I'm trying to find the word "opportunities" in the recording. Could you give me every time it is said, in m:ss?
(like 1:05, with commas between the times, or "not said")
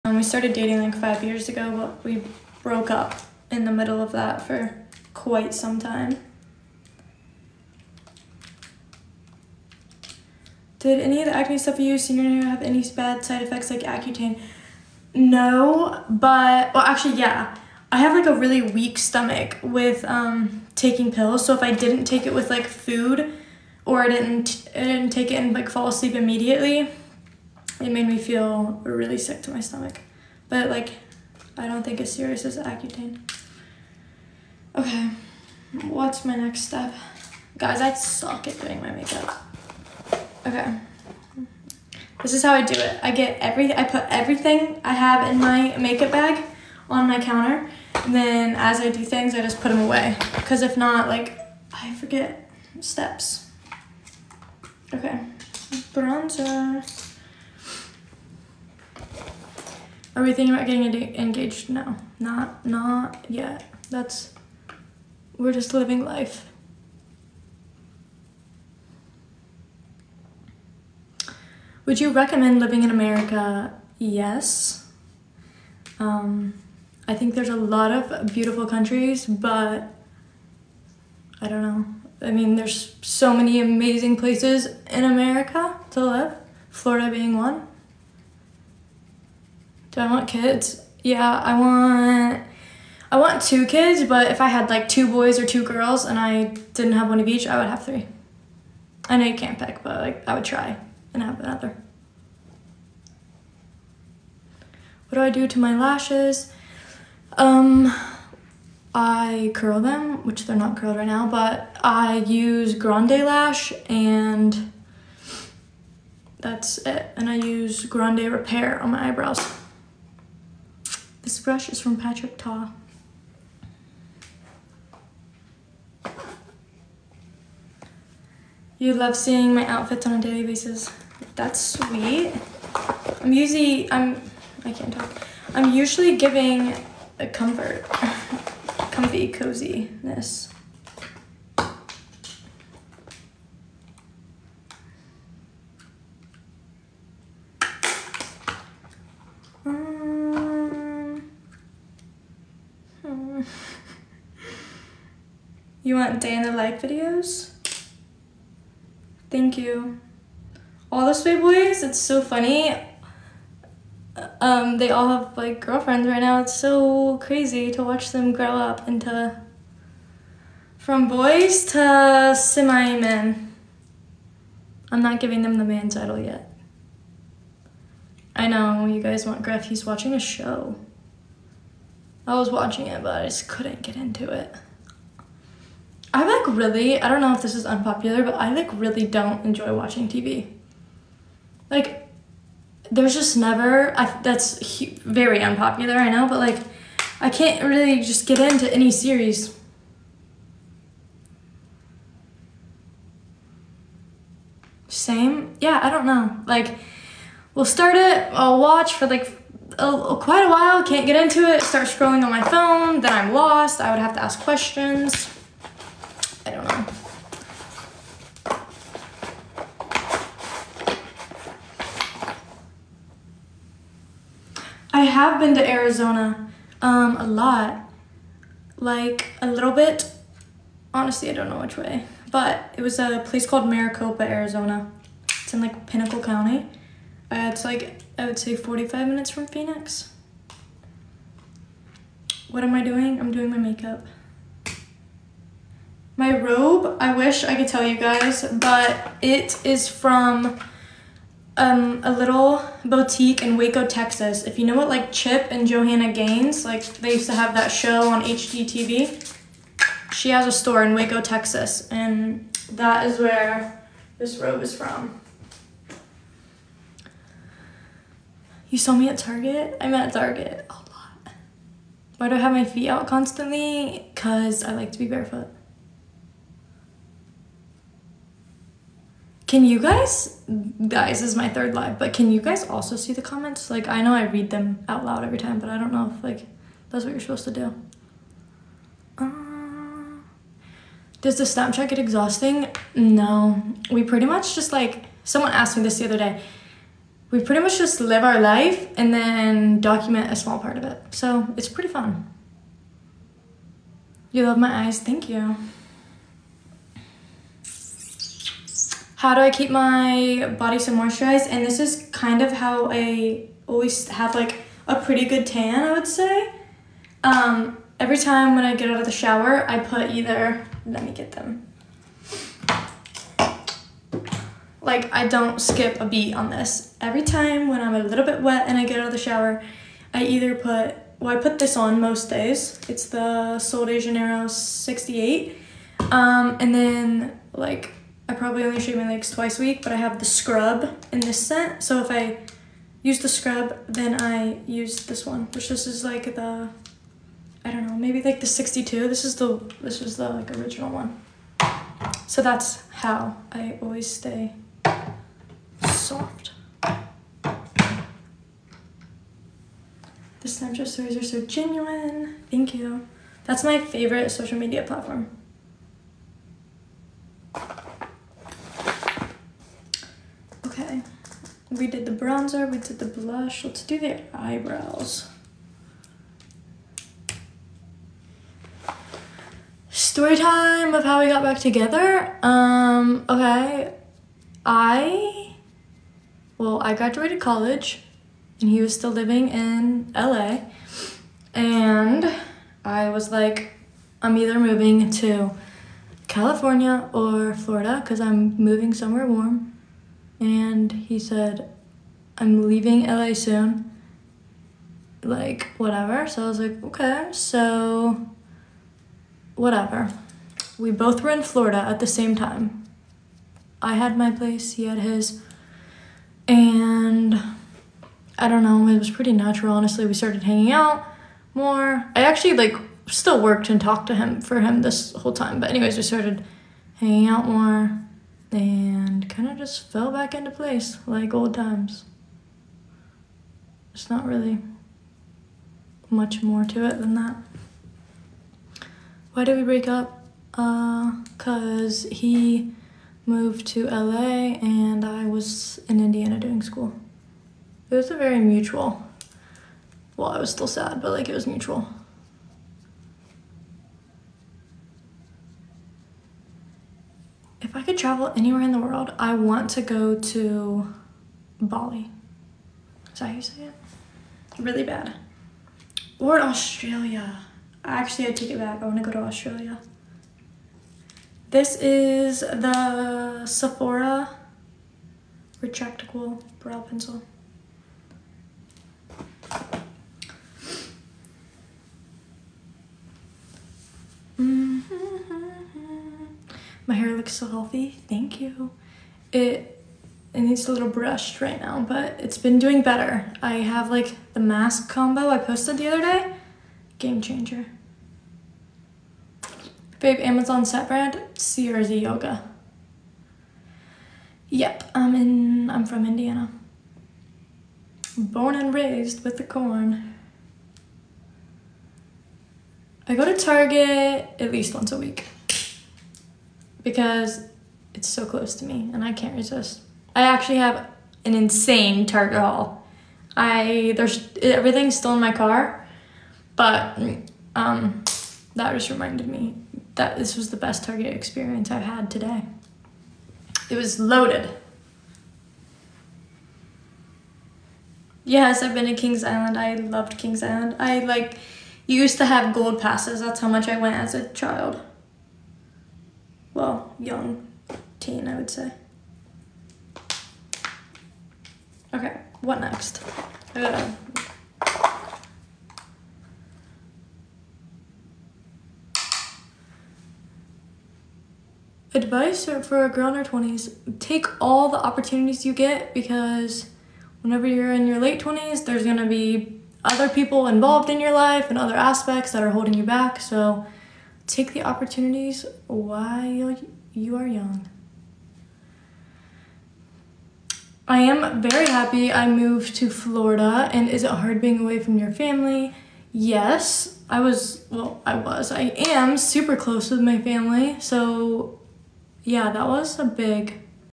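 9:24, 9:34.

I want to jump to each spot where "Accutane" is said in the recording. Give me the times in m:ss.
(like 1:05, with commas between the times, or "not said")
0:13, 0:32.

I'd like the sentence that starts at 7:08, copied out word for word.
And kind of just fell back into place like old times.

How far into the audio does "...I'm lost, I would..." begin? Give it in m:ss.
3:33.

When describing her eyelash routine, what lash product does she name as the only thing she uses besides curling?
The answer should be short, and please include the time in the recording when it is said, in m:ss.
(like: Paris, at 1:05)
Grande Lash, at 1:52.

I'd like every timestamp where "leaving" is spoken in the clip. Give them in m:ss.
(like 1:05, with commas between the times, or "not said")
6:42.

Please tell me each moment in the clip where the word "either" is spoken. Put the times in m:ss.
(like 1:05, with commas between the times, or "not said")
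5:20, 5:30, 6:34.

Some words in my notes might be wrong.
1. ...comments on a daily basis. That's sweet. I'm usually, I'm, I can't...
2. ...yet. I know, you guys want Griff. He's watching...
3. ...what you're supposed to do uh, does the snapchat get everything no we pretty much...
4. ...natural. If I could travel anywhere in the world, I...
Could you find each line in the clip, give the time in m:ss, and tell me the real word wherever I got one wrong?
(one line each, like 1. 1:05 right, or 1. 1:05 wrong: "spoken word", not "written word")
1. 2:09 wrong: "outfits", not "comments"
2. 2:56 right
3. 4:47 wrong: "exhausting", not "everything"
4. 7:31 wrong: "mutual", not "natural".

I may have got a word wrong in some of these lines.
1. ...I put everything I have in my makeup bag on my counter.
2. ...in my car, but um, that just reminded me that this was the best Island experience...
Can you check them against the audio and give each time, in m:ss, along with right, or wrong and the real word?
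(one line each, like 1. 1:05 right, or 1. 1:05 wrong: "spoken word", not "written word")
1. 0:43 right
2. 8:45 wrong: "Target", not "Island".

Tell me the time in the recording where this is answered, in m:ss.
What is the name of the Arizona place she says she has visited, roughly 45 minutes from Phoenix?
3:53.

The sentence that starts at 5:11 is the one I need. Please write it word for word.
And this is kind of how I always have like a pretty good tan, I would say.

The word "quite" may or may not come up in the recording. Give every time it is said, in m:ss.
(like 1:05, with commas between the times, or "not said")
0:05, 3:30.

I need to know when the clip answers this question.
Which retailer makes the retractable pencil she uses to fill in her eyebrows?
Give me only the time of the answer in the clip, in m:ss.
7:53.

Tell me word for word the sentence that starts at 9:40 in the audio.
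I am very happy I moved to Florida.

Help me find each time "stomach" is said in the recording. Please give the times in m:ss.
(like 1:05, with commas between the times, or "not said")
0:18, 0:29.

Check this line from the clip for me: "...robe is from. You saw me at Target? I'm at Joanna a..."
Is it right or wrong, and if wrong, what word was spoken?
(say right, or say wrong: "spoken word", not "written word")
wrong: "Target", not "Joanna".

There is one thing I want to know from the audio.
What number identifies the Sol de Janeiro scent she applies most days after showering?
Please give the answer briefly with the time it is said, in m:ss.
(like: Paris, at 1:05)
68, at 5:34.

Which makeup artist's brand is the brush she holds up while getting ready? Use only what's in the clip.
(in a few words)
Patrick Ta.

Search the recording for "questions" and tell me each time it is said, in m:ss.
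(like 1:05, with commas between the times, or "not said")
3:34.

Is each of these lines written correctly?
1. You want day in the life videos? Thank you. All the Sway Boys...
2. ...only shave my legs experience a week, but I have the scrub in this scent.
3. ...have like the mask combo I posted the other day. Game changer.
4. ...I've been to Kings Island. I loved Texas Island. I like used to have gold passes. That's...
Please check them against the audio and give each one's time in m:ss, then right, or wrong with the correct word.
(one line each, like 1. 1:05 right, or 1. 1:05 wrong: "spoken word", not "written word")
1. 2:35 right
2. 5:38 wrong: "twice", not "experience"
3. 8:13 right
4. 8:58 wrong: "Kings", not "Texas".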